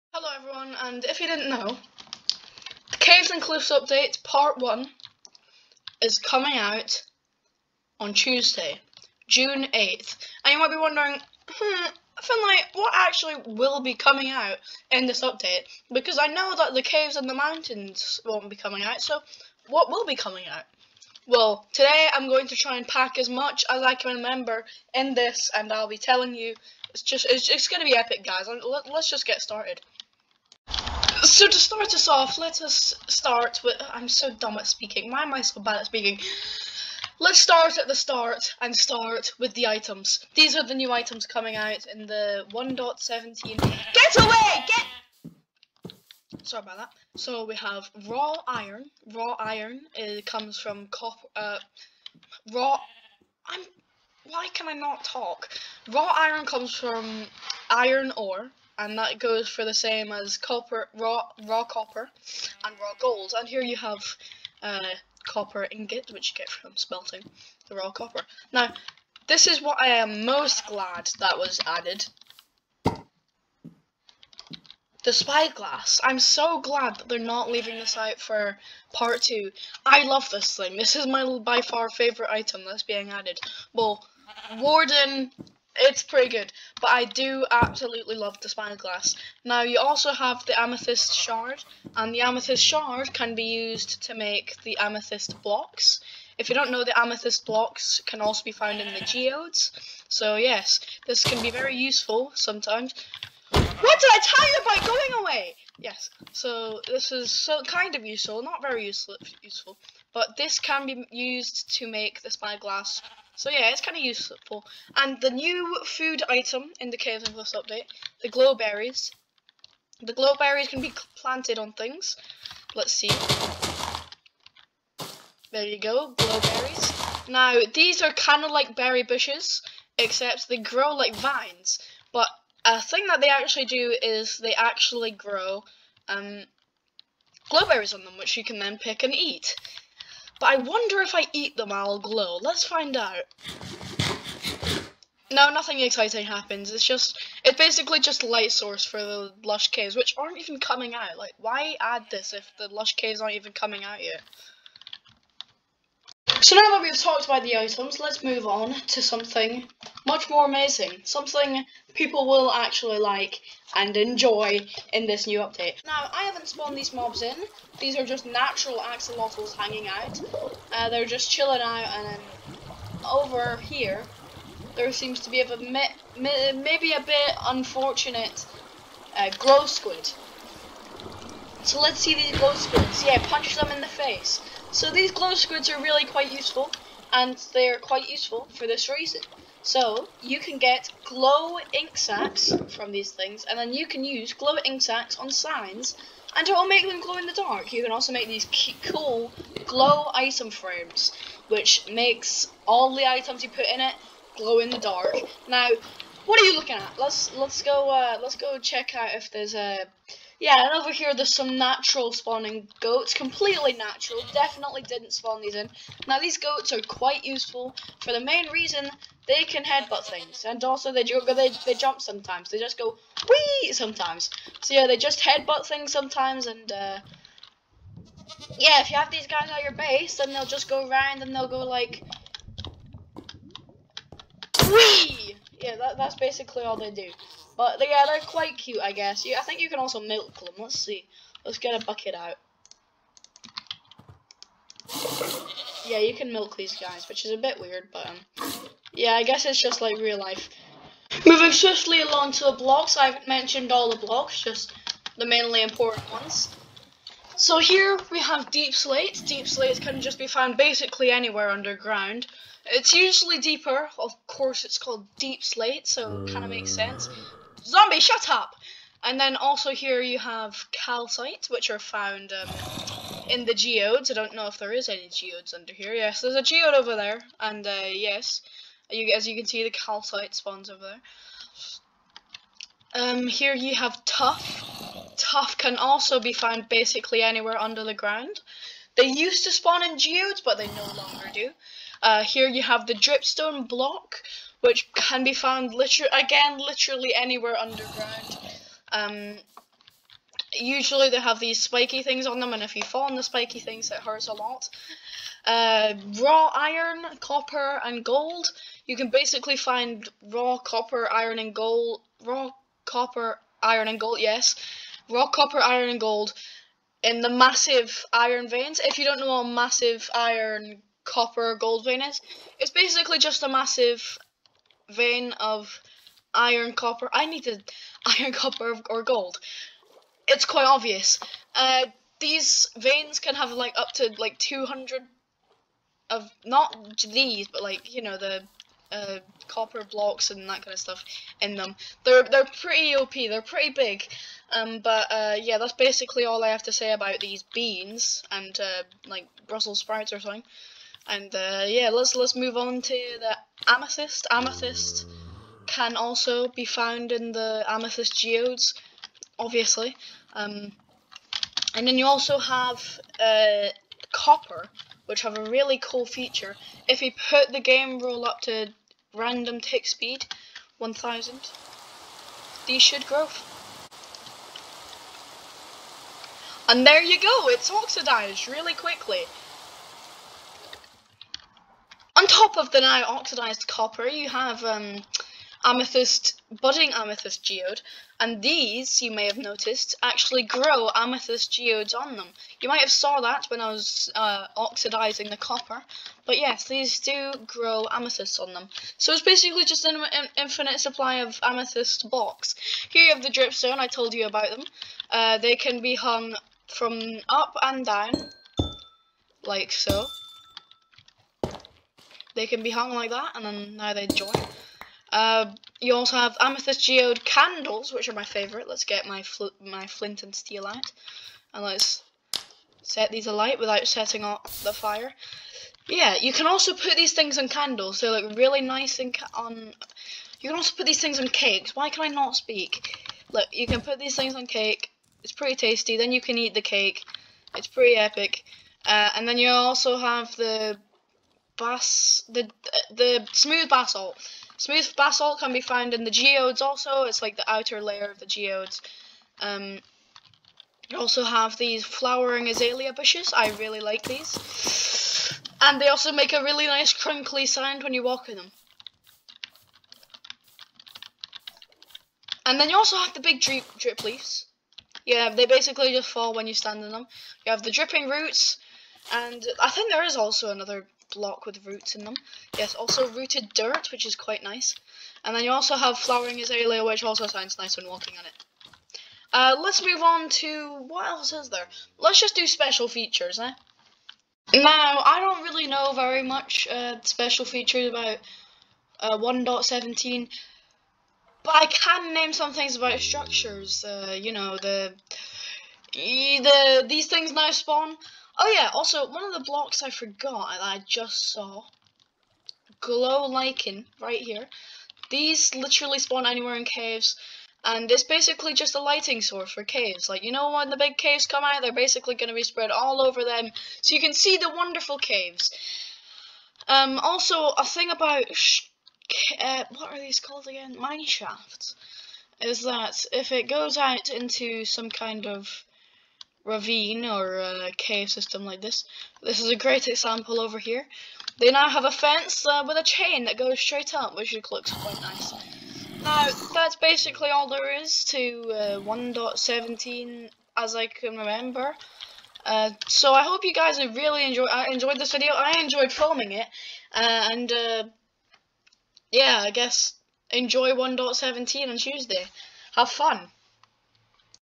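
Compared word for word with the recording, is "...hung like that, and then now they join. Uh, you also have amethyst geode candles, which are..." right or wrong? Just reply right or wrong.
right.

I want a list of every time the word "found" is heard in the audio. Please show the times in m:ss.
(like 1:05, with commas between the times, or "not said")
1:38, 4:20, 4:31, 4:46, 4:55, 5:56, 7:25.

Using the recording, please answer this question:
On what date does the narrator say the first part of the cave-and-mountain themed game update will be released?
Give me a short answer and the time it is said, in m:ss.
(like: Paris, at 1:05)
Tuesday, June 8th, at 0:08.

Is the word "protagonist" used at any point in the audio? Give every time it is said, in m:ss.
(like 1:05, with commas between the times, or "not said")
not said.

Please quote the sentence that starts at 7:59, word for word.
Uh, let's move on to, what else is there?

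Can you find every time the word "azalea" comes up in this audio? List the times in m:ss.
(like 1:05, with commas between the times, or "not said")
7:32, 7:56.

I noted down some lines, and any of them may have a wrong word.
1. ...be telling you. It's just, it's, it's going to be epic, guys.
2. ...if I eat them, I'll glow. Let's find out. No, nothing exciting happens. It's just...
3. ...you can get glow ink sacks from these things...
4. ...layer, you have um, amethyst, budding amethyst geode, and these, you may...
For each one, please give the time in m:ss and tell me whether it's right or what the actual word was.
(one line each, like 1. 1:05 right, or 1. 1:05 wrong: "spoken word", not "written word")
1. 0:25 right
2. 2:21 right
3. 3:10 right
4. 6:23 wrong: "copper", not "layer".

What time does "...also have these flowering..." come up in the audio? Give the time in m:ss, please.
7:30.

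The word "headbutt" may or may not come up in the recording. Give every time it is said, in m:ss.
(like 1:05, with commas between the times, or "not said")
3:39, 3:45.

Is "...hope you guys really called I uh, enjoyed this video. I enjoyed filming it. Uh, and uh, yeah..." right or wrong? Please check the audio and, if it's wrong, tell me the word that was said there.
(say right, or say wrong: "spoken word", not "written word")
wrong: "enjoyed", not "called".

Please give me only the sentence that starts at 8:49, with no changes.
This is a great example over here.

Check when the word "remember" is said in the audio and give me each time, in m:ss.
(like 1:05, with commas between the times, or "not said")
0:24, 9:01.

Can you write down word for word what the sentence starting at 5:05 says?
Uh, raw iron, copper, and gold.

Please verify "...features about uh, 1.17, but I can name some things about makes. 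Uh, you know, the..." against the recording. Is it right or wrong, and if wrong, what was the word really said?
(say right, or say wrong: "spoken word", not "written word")
wrong: "structures", not "makes".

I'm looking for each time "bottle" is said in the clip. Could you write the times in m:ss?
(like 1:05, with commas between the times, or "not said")
not said.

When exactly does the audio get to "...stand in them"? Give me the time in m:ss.
7:46.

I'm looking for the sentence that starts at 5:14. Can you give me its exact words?
Yes, raw copper, iron, and gold in the massive iron veins.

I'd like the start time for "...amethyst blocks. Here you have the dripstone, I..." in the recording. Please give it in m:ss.
6:41.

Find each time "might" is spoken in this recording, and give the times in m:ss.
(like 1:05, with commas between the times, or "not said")
0:10, 6:32.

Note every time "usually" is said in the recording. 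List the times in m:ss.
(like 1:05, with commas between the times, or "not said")
4:22, 5:00.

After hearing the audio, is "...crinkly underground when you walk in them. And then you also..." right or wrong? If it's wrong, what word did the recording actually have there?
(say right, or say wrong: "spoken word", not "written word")
wrong: "sound", not "underground".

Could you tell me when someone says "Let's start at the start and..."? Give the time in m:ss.
0:37.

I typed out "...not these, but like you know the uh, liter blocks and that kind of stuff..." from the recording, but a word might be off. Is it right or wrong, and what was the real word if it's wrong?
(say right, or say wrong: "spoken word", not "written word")
wrong: "copper", not "liter".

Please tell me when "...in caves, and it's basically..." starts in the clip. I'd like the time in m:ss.
8:26.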